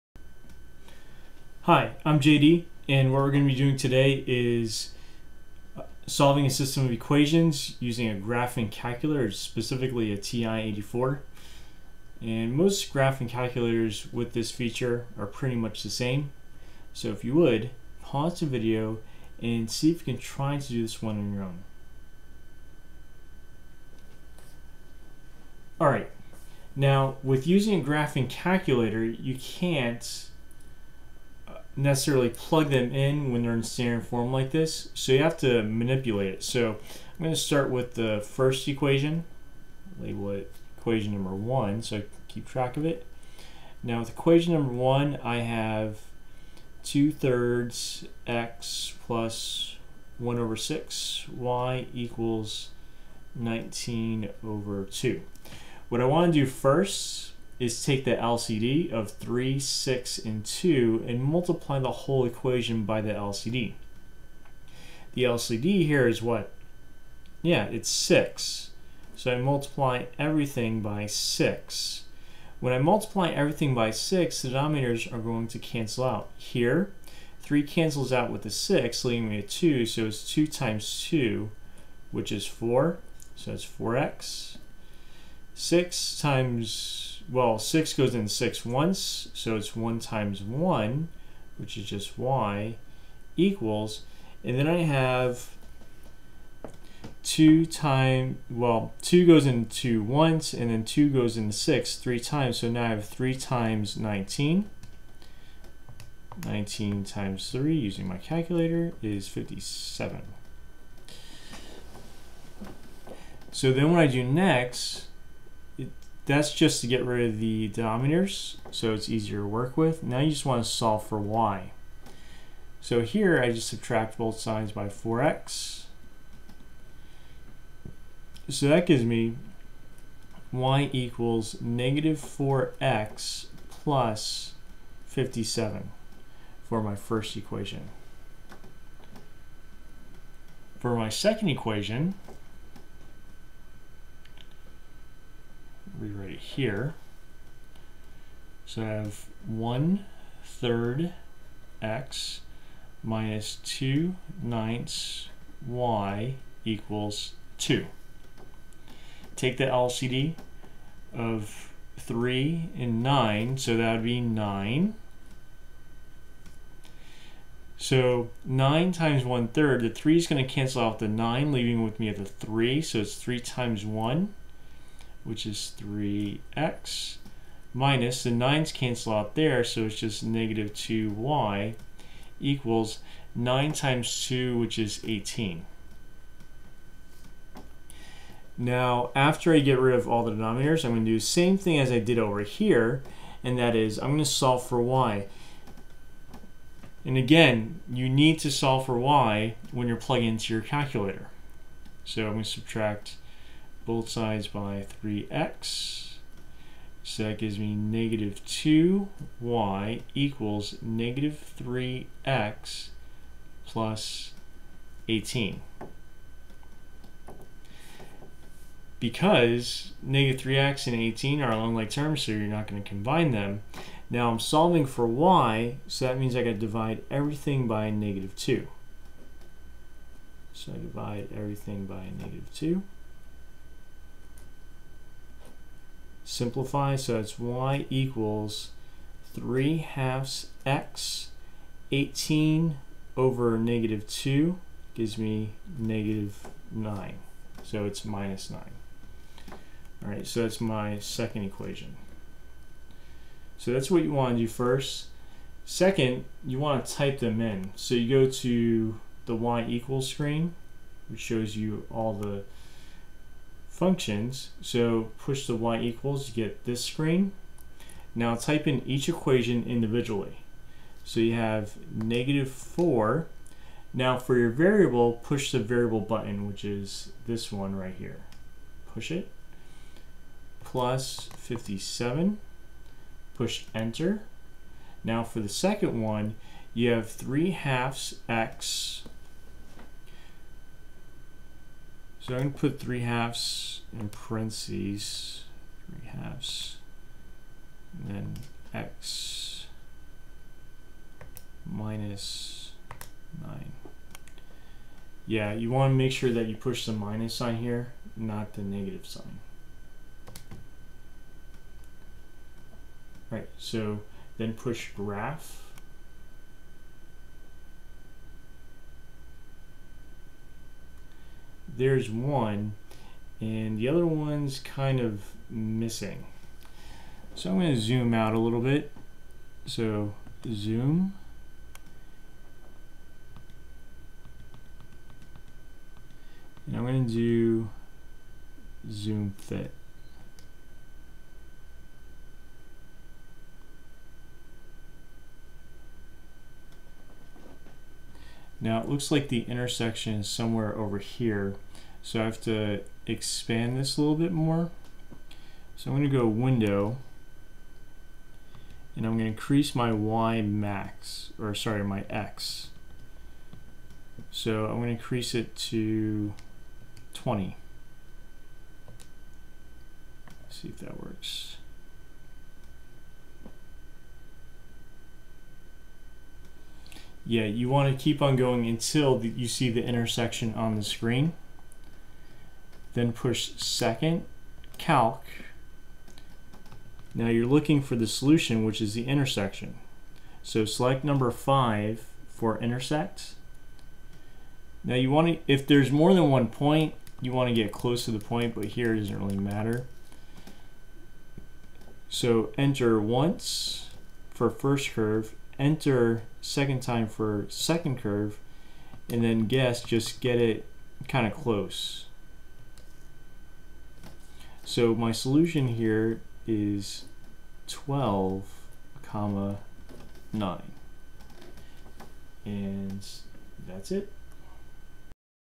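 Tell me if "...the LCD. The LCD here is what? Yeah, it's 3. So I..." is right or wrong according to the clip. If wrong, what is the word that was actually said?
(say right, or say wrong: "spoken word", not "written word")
wrong: "6", not "3".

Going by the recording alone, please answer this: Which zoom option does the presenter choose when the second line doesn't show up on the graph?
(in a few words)
Zoom fit.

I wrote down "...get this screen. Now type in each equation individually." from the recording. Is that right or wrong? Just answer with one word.
right.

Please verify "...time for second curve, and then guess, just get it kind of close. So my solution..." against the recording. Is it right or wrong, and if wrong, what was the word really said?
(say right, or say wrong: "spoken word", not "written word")
right.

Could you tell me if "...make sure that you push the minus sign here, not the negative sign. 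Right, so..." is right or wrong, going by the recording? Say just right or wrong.
right.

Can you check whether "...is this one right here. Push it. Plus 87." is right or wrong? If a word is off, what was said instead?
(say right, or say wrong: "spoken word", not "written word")
wrong: "57", not "87".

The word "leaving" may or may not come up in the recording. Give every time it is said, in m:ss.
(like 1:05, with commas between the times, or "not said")
1:19, 2:51.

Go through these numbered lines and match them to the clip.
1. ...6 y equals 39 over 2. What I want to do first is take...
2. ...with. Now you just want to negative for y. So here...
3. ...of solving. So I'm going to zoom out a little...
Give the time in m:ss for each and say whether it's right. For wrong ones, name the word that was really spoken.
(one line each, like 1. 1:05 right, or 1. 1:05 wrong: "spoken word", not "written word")
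1. 0:50 wrong: "19", not "39"
2. 1:59 wrong: "solve", not "negative"
3. 5:24 wrong: "missing", not "solving".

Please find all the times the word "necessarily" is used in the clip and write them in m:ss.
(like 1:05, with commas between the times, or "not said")
0:31.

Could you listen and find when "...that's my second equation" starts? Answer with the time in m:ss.
4:10.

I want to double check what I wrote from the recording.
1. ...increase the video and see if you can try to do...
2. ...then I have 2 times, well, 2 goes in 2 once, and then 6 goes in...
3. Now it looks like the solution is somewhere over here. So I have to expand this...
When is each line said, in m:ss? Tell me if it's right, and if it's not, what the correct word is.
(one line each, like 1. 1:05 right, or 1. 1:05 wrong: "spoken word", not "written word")
1. 0:18 wrong: "pause", not "increase"
2. 1:34 wrong: "2", not "6"
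3. 5:48 wrong: "intersection", not "solution".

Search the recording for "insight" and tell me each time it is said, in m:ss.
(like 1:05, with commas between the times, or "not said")
not said.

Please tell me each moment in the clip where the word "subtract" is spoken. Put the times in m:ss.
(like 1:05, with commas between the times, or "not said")
2:03, 3:22.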